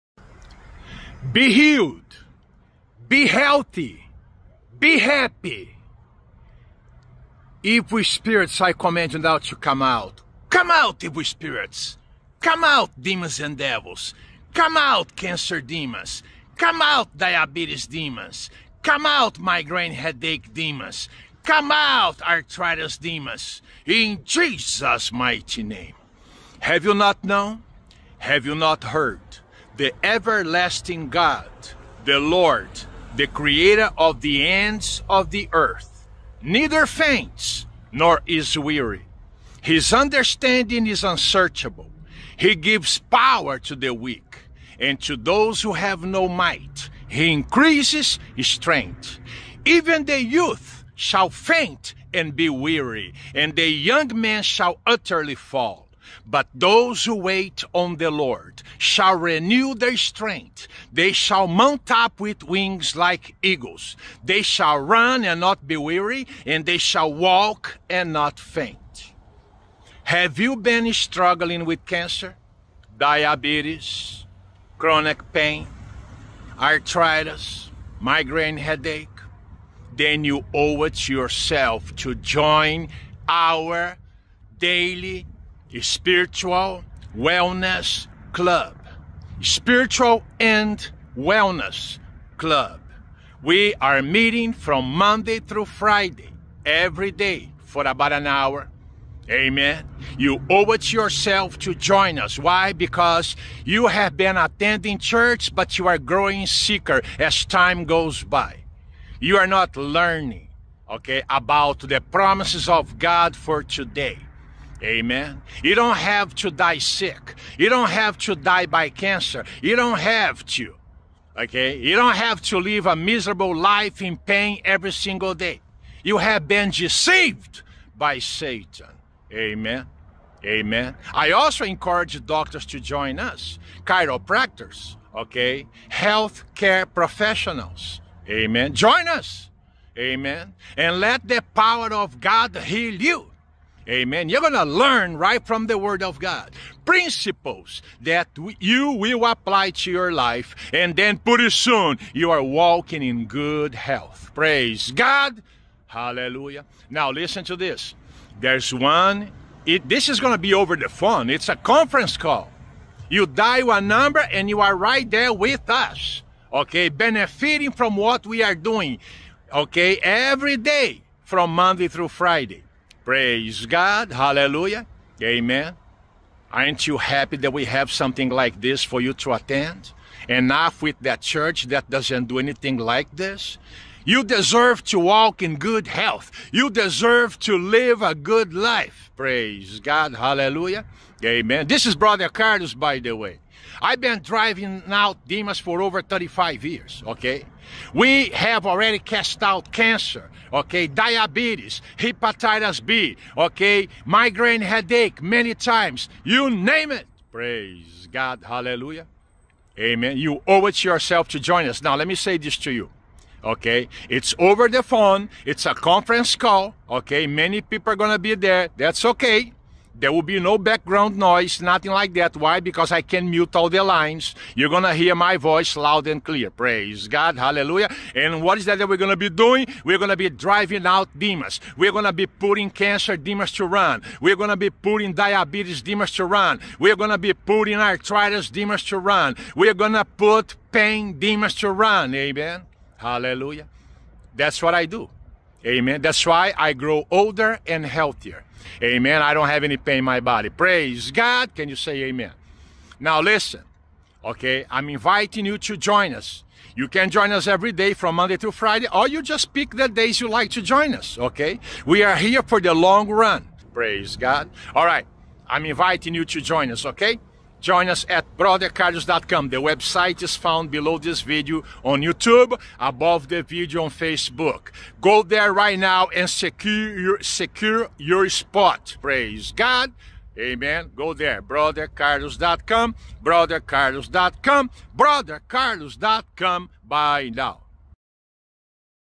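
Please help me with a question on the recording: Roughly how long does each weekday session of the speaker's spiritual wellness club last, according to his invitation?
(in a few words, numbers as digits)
About an hour.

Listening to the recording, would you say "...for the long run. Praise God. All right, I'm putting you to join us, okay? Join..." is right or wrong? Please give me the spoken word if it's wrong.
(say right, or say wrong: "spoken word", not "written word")
wrong: "inviting", not "putting".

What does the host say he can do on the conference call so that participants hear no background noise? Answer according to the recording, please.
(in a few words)
Mute all the lines.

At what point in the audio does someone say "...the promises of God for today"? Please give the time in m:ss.
1:51.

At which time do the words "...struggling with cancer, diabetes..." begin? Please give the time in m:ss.
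1:10.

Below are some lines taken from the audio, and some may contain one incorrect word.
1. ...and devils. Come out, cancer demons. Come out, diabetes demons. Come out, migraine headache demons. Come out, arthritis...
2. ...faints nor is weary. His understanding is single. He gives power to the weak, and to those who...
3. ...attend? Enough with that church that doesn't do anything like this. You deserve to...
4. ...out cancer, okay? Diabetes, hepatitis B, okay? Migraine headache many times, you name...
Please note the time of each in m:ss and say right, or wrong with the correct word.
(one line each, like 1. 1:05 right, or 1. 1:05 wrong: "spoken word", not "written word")
1. 0:13 right
2. 0:36 wrong: "unsearchable", not "single"
3. 2:59 right
4. 3:19 right.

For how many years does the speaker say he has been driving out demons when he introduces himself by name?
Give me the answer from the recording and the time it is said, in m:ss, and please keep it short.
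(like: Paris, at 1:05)
35 years, at 3:16.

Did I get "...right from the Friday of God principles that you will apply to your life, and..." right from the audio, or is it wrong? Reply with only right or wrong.
wrong.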